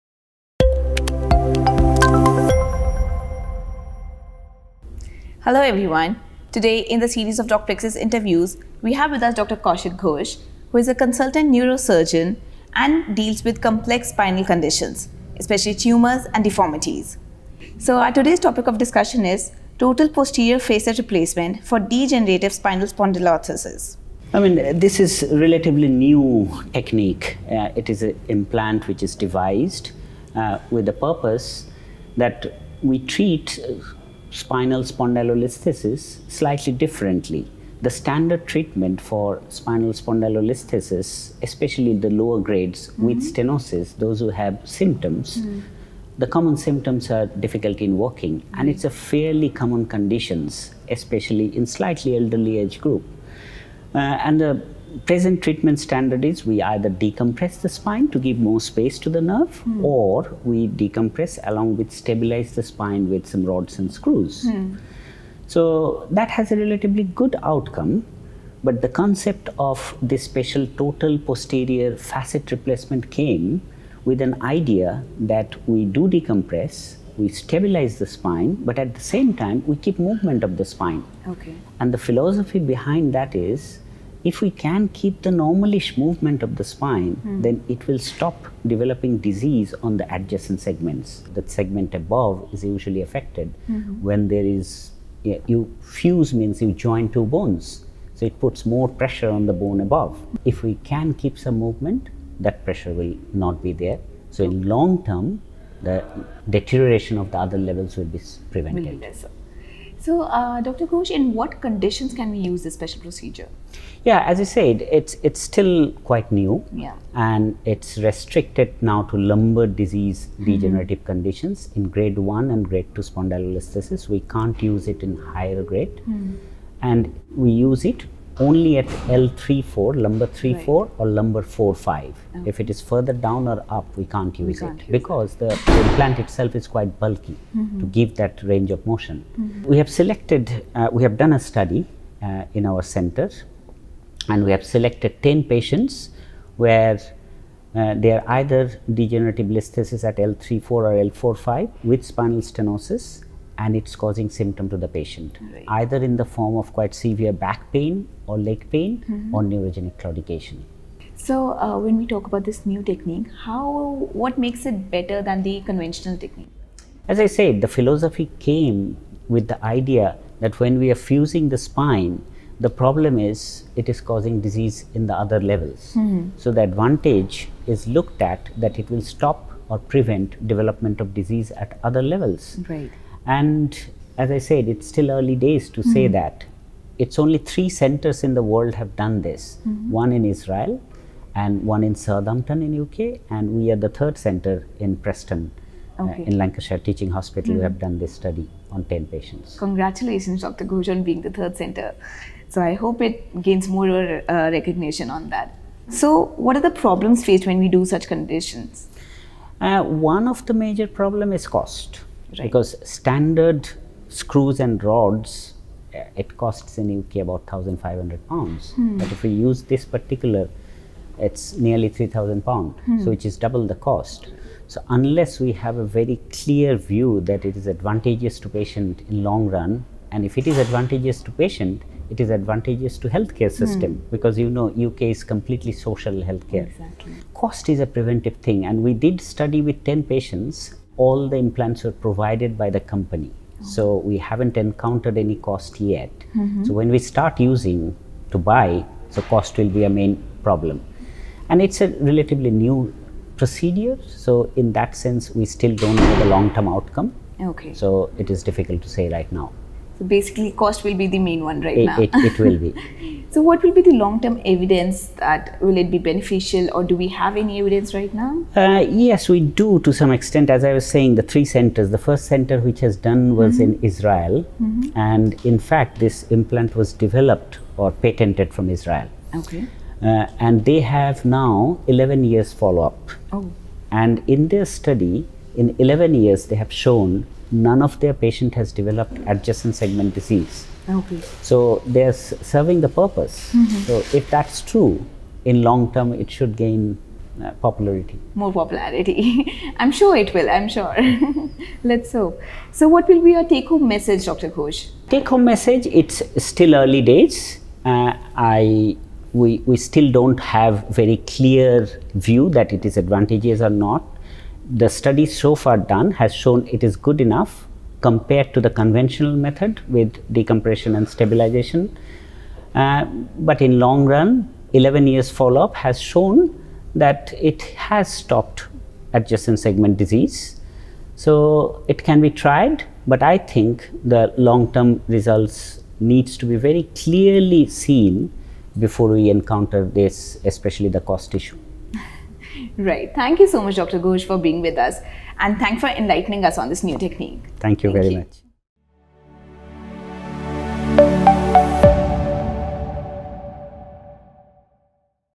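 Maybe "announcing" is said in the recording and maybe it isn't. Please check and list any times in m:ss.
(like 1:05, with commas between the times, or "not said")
not said.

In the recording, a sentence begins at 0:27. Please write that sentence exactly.
Uh, it is an implant which is devised uh, with the purpose that we treat spinal spondylolisthesis slightly differently.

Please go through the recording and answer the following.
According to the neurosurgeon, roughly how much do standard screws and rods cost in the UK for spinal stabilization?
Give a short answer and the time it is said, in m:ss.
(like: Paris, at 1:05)
1,500 pounds, at 3:37.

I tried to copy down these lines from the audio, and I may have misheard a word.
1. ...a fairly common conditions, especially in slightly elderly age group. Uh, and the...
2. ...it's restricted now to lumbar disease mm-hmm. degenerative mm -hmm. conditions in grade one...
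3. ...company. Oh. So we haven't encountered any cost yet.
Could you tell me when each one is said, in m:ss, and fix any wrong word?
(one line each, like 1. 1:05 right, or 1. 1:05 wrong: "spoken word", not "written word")
1. 0:48 right
2. 1:57 right
3. 4:02 right.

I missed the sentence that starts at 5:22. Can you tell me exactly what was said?
Uh, but in long run, 11 years follow-up has shown that it has stopped adjacent segment disease.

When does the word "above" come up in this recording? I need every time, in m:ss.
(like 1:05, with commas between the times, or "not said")
1:31, 1:39.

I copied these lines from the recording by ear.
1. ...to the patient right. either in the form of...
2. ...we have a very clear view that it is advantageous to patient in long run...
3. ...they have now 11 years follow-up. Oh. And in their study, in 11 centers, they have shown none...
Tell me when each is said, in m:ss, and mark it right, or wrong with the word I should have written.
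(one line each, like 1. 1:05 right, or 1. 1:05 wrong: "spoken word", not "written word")
1. 2:34 right
2. 3:45 right
3. 4:40 wrong: "years", not "centers".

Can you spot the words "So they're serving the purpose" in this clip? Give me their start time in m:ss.
4:51.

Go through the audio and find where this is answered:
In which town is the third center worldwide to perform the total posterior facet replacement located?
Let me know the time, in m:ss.
3:14.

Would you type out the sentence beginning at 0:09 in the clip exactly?
Kaushik Ghosh, who is a consultant neurosurgeon and deals with complex spinal conditions, especially tumors and deformities.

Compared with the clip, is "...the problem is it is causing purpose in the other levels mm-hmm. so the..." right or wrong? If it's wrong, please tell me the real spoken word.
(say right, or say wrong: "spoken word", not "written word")
wrong: "disease", not "purpose".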